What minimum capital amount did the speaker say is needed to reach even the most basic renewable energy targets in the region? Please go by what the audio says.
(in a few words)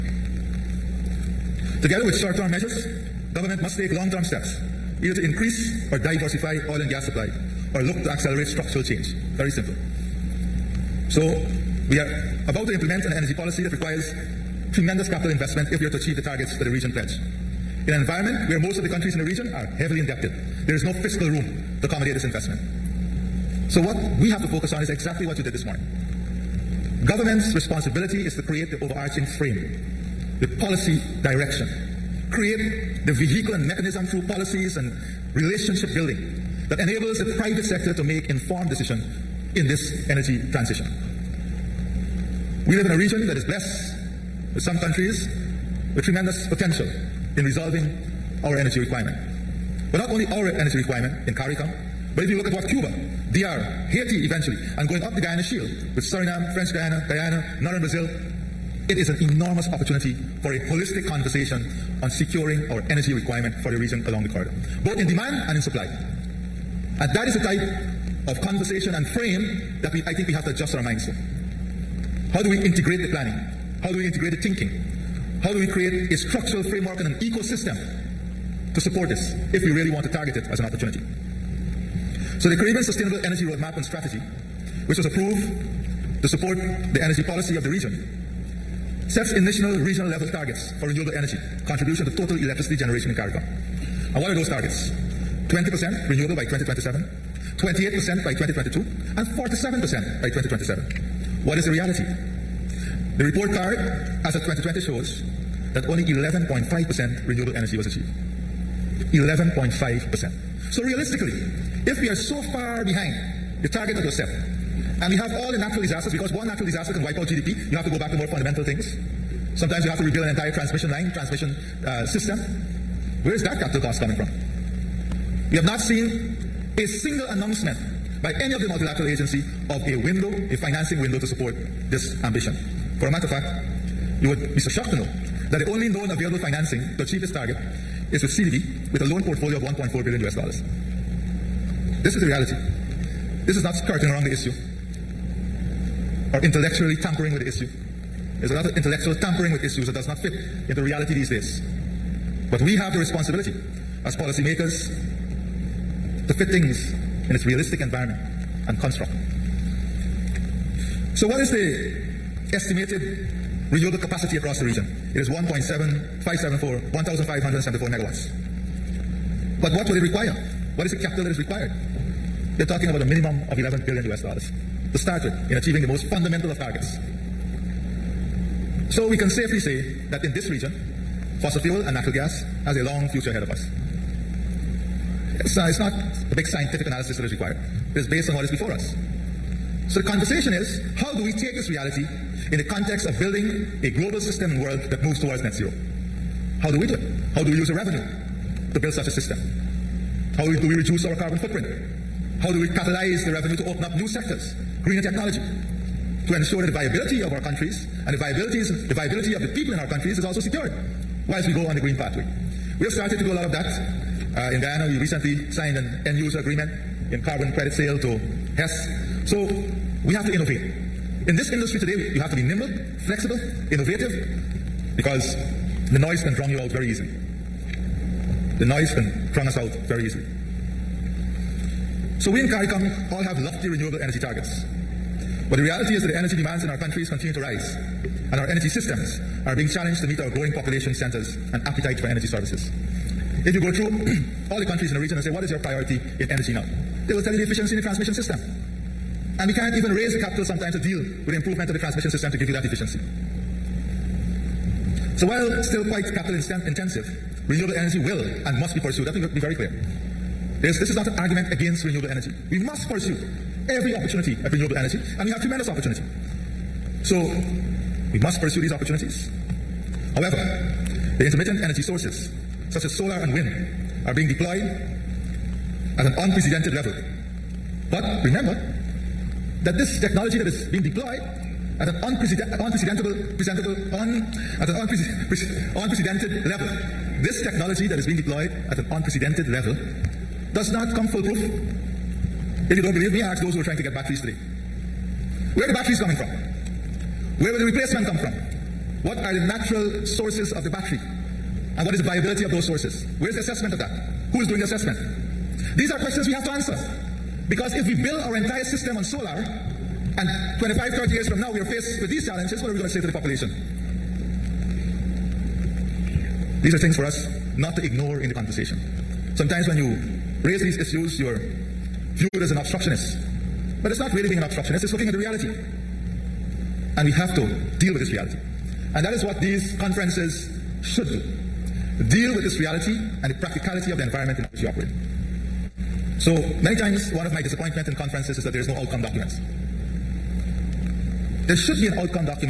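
11 billion US dollars.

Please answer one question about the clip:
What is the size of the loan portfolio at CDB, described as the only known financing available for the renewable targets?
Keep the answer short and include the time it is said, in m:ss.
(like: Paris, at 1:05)
1.4 billion US dollars, at 2:19.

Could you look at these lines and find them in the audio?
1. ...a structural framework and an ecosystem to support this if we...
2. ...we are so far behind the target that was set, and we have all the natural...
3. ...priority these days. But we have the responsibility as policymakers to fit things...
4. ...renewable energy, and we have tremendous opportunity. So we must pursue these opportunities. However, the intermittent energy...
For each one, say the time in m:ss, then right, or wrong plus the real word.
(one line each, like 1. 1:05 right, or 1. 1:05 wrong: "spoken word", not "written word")
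1. 1:16 right
2. 1:52 right
3. 2:30 wrong: "reality", not "priority"
4. 4:24 right.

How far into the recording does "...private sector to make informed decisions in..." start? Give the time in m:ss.
0:37.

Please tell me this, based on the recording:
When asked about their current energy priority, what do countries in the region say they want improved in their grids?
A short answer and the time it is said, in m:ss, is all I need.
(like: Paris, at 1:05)
efficiency in the transmission system, at 4:07.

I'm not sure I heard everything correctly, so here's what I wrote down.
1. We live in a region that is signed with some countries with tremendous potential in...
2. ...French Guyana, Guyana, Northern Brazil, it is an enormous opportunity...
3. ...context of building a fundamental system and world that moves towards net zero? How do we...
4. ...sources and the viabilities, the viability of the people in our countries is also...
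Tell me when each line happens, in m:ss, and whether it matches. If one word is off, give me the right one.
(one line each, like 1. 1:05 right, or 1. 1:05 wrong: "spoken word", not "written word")
1. 0:42 wrong: "blessed", not "signed"
2. 0:56 right
3. 3:12 wrong: "global", not "fundamental"
4. 3:27 wrong: "countries", not "sources".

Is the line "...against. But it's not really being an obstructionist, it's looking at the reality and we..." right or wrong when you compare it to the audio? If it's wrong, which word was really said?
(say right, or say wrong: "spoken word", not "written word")
wrong: "obstructionist", not "against".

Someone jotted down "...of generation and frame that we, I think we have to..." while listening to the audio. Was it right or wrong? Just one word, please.
wrong.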